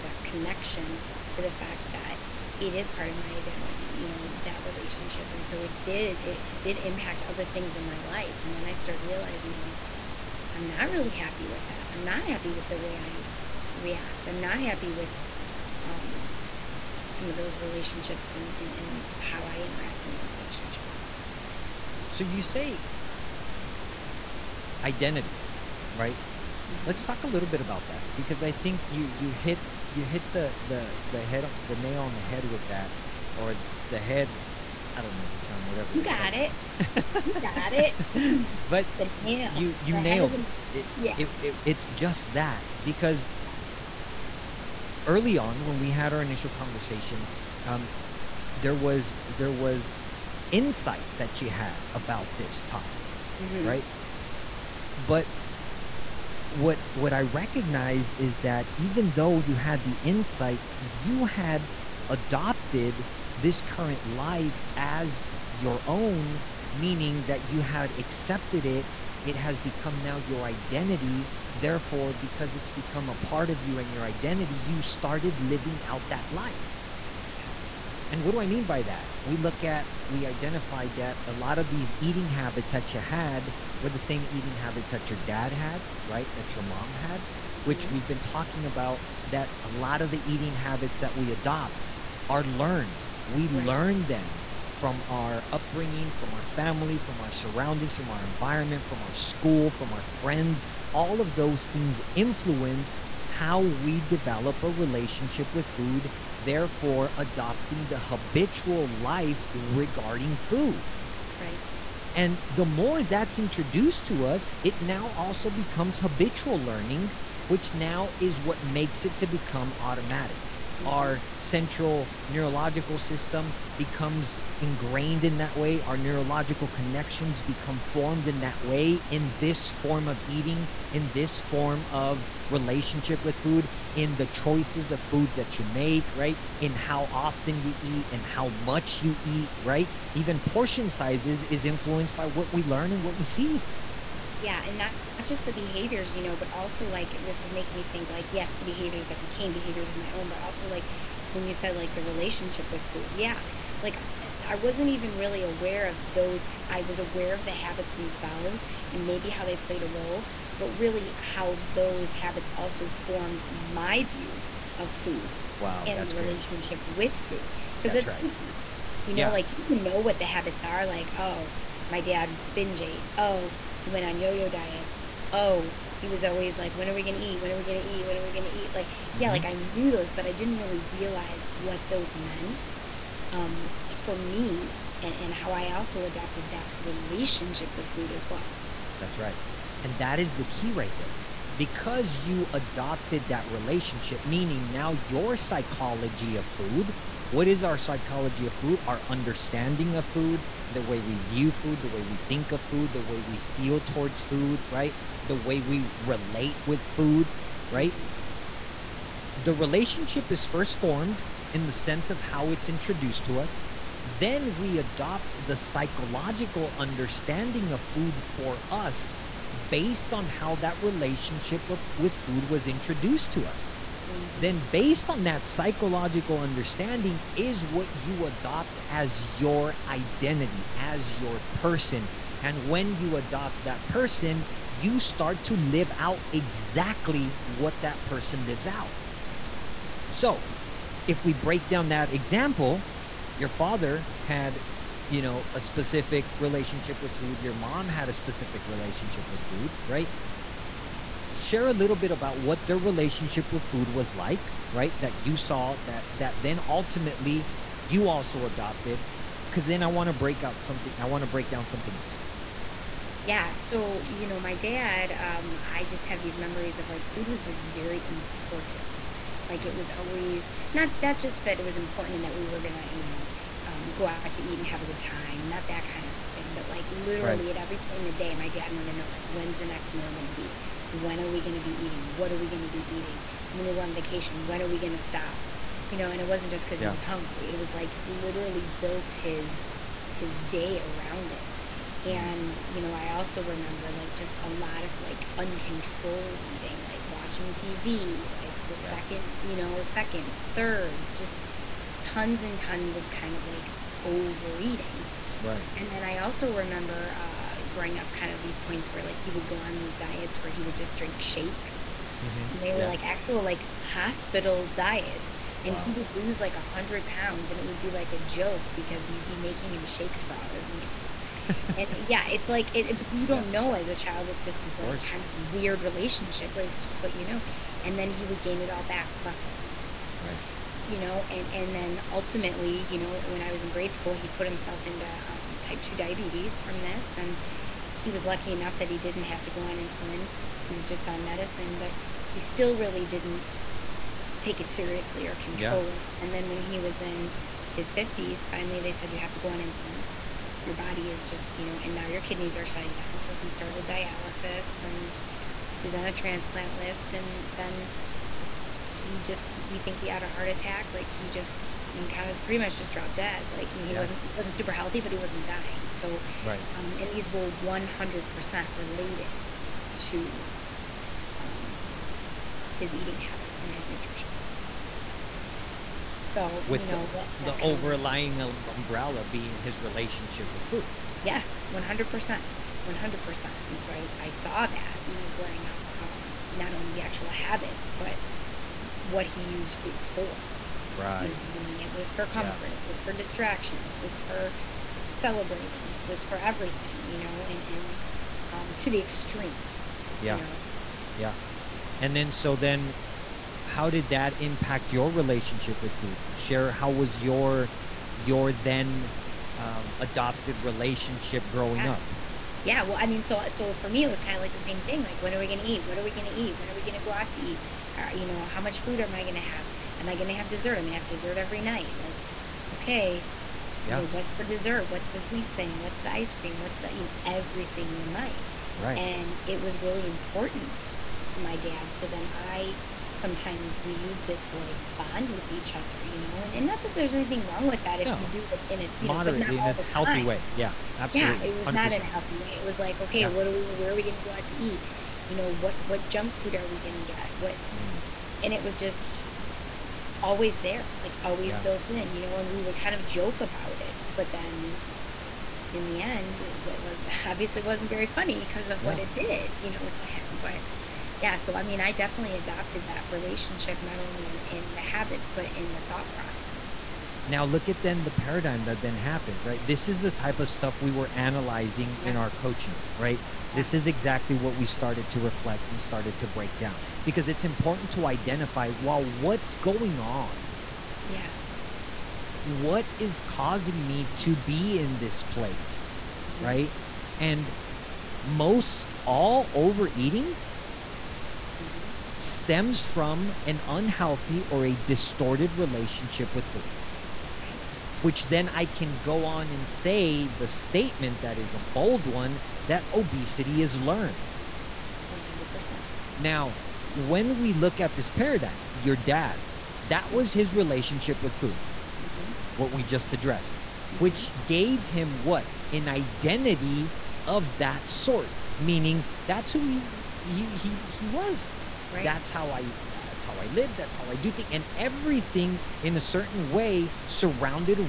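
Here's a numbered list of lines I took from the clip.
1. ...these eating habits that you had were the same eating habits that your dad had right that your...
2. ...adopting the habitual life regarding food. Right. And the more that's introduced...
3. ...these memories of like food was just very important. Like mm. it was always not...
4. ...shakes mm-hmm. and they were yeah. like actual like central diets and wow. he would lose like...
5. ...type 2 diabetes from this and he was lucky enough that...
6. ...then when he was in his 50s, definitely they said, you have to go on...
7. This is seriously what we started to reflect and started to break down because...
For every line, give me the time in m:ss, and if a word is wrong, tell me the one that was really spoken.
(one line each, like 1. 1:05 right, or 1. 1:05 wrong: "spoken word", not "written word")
1. 1:21 right
2. 1:47 right
3. 4:26 right
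4. 5:11 wrong: "hospital", not "central"
5. 5:35 right
6. 5:46 wrong: "finally", not "definitely"
7. 7:53 wrong: "exactly", not "seriously".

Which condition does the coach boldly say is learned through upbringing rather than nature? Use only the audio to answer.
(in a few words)
obesity.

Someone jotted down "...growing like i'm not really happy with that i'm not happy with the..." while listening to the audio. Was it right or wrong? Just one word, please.
wrong.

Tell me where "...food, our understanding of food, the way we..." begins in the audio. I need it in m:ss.
3:18.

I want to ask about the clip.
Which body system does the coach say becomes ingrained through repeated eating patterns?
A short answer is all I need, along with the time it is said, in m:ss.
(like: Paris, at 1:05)
central neurological system, at 2:01.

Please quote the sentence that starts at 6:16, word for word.
So, with you know, the, that, the overlying um, umbrella being his relationship with food.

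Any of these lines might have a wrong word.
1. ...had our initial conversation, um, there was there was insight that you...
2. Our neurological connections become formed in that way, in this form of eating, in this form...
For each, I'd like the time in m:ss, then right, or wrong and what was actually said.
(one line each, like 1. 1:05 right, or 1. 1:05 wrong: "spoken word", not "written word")
1. 0:45 right
2. 2:05 right.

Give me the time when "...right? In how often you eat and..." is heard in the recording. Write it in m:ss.
2:16.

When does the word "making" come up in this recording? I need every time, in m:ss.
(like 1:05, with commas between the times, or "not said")
2:27, 5:19.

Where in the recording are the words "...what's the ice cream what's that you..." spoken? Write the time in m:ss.
7:05.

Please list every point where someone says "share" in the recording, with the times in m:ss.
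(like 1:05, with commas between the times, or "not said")
4:11, 6:46.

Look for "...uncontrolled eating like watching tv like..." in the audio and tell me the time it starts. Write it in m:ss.
4:55.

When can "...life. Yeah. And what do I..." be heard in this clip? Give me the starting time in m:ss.
1:16.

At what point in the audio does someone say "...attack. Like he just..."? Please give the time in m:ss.
6:00.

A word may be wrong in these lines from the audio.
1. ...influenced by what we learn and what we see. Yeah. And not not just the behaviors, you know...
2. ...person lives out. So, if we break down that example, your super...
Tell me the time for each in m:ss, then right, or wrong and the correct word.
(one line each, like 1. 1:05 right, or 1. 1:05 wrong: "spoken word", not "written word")
1. 2:21 right
2. 3:58 wrong: "father", not "super".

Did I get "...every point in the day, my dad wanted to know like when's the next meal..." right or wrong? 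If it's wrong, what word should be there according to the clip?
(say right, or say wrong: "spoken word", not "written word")
right.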